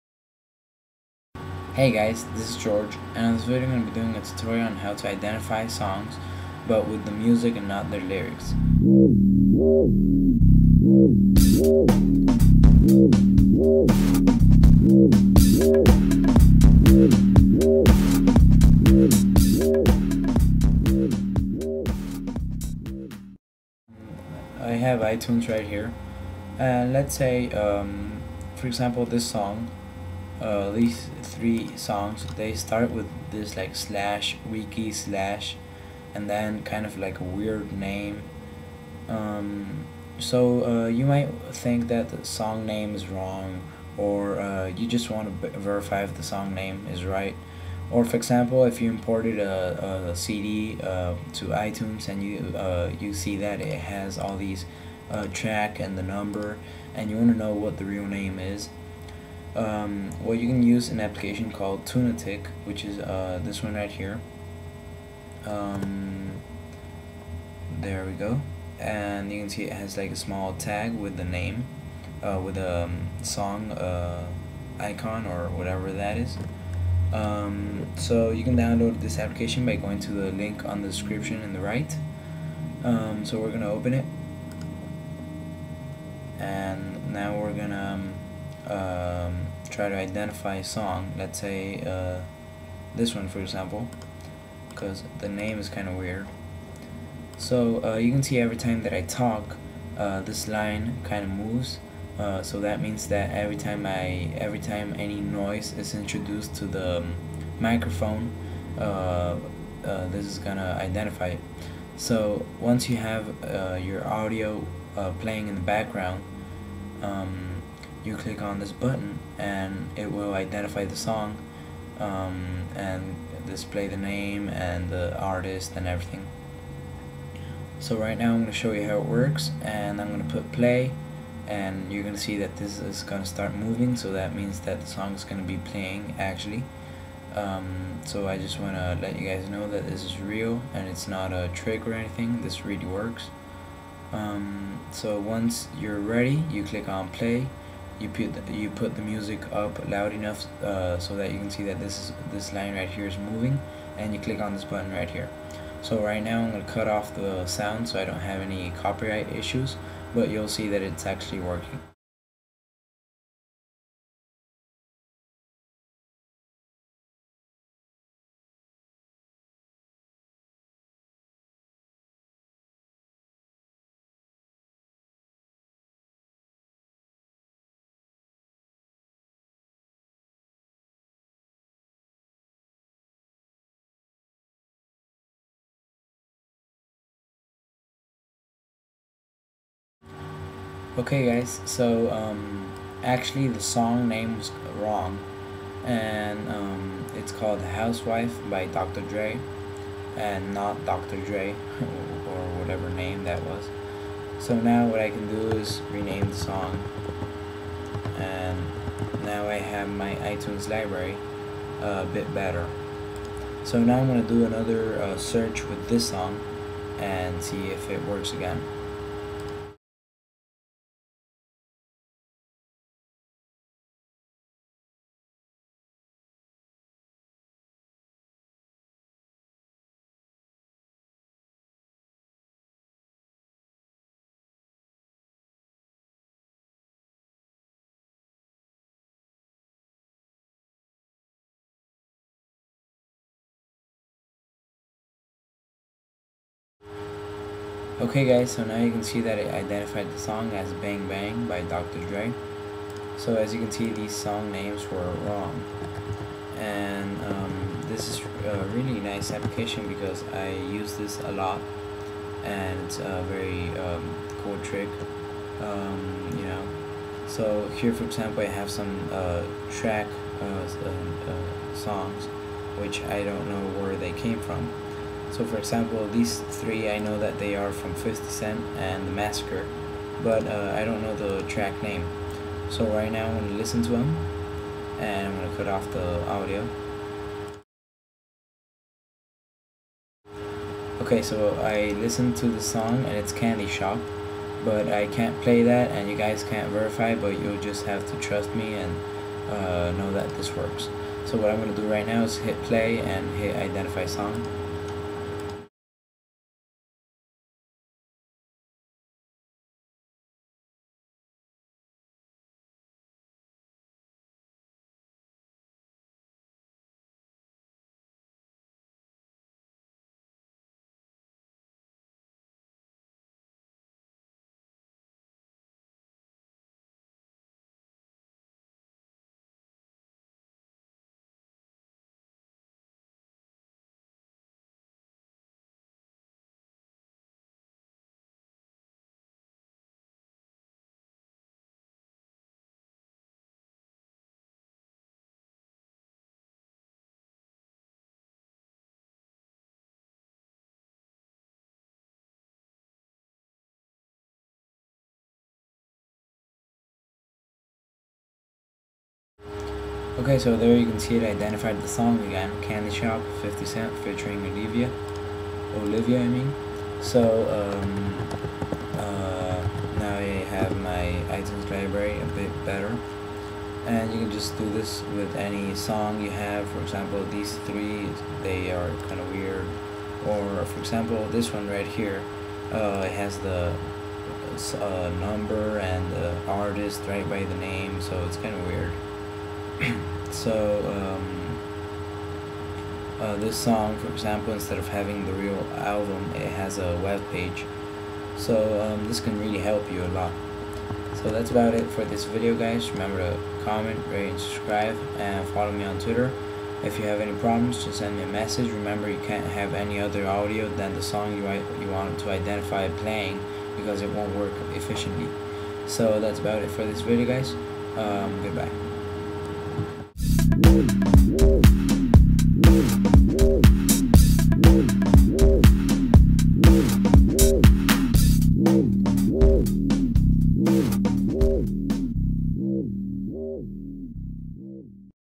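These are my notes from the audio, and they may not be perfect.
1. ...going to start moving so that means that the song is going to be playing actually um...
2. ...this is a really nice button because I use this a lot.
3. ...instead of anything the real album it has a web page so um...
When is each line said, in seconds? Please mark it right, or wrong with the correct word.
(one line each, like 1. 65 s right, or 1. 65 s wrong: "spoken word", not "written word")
1. 133 s right
2. 257 s wrong: "application", not "button"
3. 394 s wrong: "having", not "anything".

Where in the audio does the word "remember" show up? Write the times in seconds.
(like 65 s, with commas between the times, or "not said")
402 s, 408 s.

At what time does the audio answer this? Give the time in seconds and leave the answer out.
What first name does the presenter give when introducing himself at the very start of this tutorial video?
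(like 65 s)
2 s.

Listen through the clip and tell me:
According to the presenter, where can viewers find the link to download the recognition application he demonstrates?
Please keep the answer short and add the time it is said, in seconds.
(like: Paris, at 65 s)
The description, at 80 s.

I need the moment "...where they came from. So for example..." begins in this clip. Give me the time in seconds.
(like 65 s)
273 s.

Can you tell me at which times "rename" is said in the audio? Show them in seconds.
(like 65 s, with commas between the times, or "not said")
205 s.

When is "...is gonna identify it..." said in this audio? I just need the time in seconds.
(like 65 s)
110 s.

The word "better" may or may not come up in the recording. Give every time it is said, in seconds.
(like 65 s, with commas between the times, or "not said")
212 s, 372 s.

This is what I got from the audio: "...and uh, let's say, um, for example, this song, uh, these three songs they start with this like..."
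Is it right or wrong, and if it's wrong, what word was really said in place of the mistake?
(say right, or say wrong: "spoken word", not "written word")
right.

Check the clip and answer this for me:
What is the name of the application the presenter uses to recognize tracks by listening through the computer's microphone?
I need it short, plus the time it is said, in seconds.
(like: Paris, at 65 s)
Tunatic, at 61 s.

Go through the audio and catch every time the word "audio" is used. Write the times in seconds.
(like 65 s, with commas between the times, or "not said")
114 s, 286 s, 410 s.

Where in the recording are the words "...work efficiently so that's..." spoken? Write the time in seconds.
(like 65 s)
414 s.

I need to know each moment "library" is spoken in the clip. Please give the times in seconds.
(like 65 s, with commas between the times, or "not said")
210 s, 371 s.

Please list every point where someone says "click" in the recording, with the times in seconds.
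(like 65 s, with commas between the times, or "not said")
118 s, 146 s, 154 s.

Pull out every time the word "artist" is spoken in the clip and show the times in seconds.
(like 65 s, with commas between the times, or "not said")
125 s, 386 s.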